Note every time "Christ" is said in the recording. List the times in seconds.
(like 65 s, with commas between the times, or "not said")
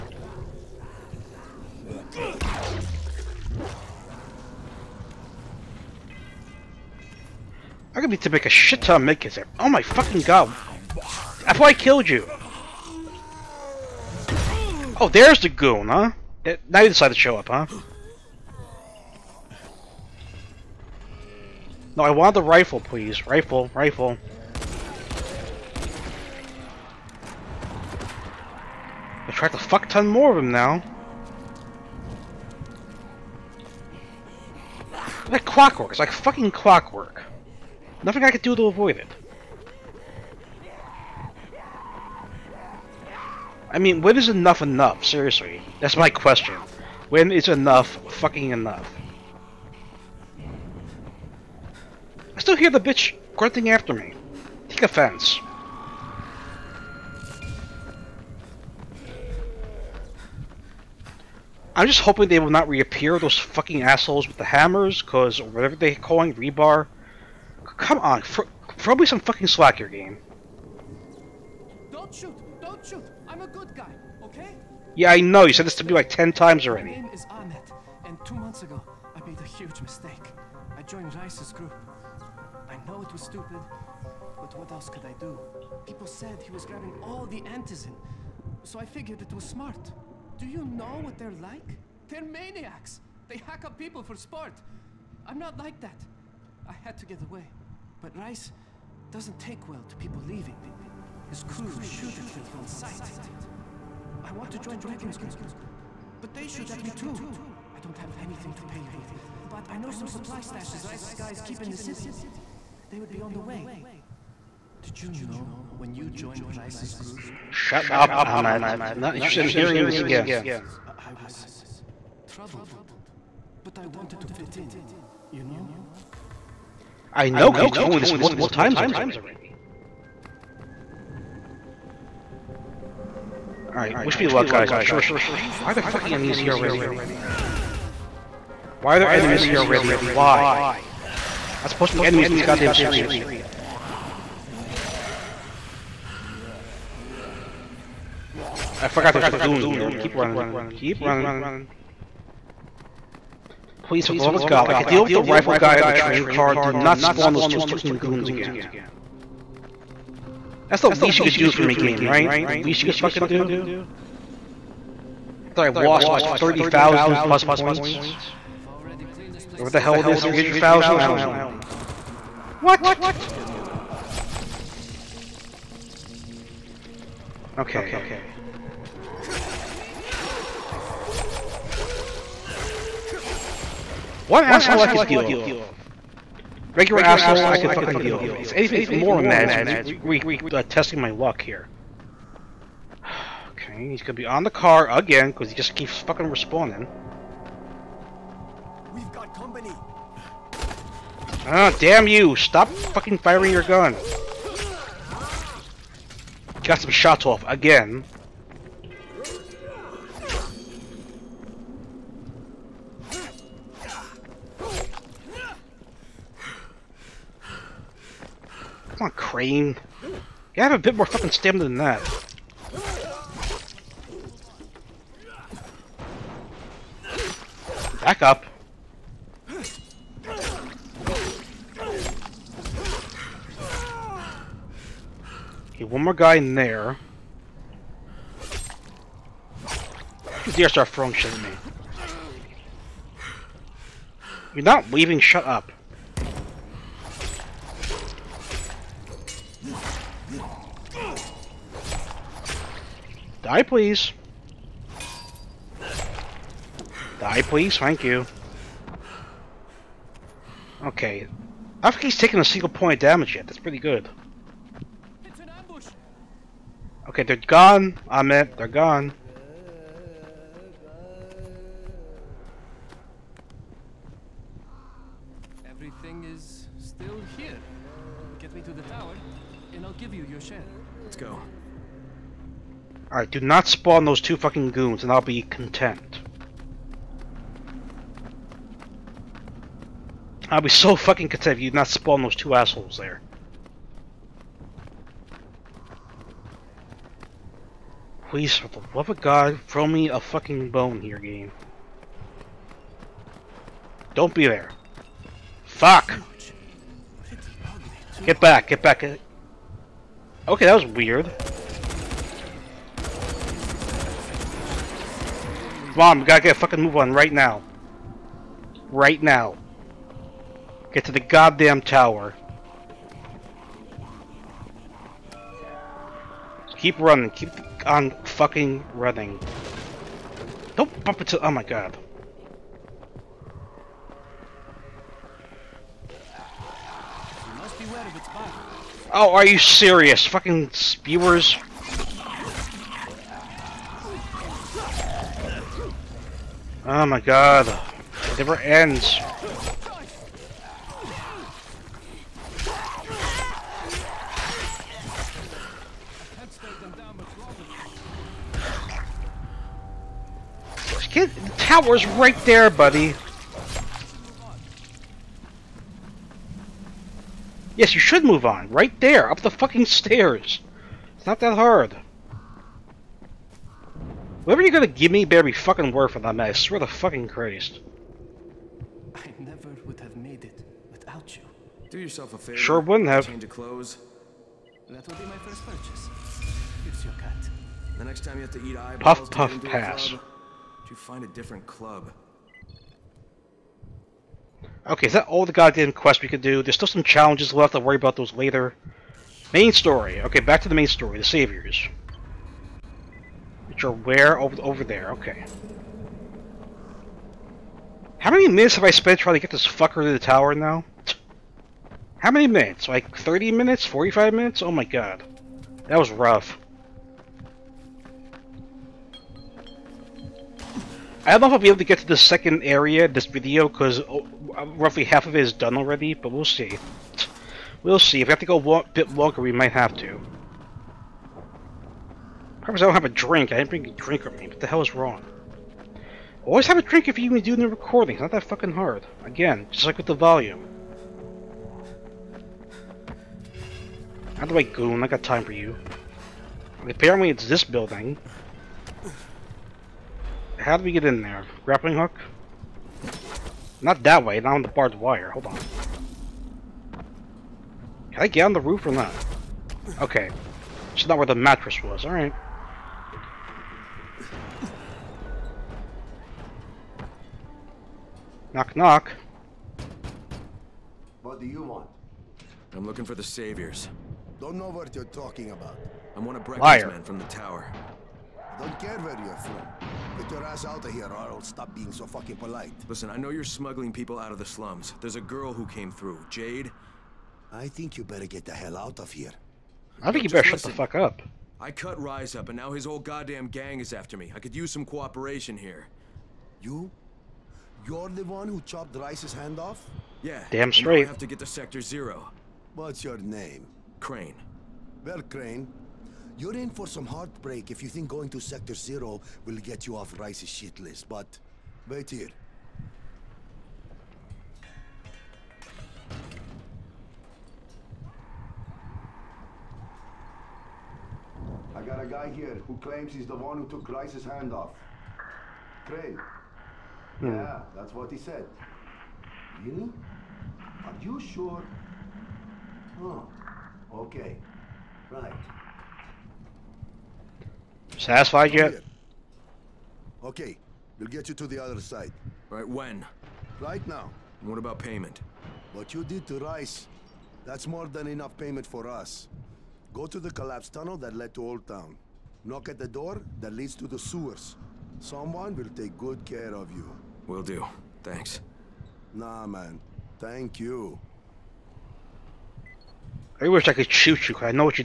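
377 s.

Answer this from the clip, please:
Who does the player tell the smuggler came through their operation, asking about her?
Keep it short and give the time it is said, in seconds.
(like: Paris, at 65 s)
Jade, at 486 s.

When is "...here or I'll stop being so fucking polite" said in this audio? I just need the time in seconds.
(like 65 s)
480 s.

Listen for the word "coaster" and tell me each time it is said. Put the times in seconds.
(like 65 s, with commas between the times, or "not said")
not said.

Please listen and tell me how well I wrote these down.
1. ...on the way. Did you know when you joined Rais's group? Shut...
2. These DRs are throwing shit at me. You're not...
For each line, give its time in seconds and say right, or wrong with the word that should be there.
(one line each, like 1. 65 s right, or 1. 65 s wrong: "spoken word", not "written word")
1. 113 s right
2. 240 s right.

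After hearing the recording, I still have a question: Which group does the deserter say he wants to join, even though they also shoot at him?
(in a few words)
Brecken's group.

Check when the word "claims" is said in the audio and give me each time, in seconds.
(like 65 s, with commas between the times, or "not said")
522 s.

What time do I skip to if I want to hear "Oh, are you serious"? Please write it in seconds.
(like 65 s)
339 s.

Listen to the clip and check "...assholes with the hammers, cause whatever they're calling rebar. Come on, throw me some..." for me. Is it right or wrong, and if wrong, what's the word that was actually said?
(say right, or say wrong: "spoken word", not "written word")
right.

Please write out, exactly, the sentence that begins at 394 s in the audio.
Okay, is that all the goddamn quests we could do?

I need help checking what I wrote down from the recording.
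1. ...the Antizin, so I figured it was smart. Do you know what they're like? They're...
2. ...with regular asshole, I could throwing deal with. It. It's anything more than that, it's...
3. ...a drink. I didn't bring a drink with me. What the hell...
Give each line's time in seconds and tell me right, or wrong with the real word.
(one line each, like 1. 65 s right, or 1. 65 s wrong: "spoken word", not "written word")
1. 87 s right
2. 185 s wrong: "fucking", not "throwing"
3. 433 s right.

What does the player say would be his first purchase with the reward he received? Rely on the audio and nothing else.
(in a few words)
Change of clothes.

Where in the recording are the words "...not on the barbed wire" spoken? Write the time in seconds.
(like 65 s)
454 s.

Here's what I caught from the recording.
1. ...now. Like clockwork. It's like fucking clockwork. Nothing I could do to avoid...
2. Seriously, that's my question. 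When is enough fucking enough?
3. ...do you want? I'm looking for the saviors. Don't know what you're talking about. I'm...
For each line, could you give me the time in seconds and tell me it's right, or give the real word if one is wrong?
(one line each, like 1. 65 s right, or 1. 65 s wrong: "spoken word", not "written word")
1. 30 s right
2. 45 s right
3. 471 s right.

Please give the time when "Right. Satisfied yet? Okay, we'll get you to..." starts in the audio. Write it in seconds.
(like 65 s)
535 s.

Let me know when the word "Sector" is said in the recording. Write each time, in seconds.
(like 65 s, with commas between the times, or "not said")
501 s, 508 s.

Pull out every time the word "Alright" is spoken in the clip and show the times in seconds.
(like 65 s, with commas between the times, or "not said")
133 s, 462 s.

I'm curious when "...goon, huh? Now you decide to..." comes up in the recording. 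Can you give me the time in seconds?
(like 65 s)
15 s.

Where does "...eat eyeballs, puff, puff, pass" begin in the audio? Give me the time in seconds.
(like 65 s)
388 s.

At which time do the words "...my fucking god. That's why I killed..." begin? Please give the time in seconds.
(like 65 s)
9 s.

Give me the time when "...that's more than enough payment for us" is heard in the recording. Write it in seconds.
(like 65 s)
547 s.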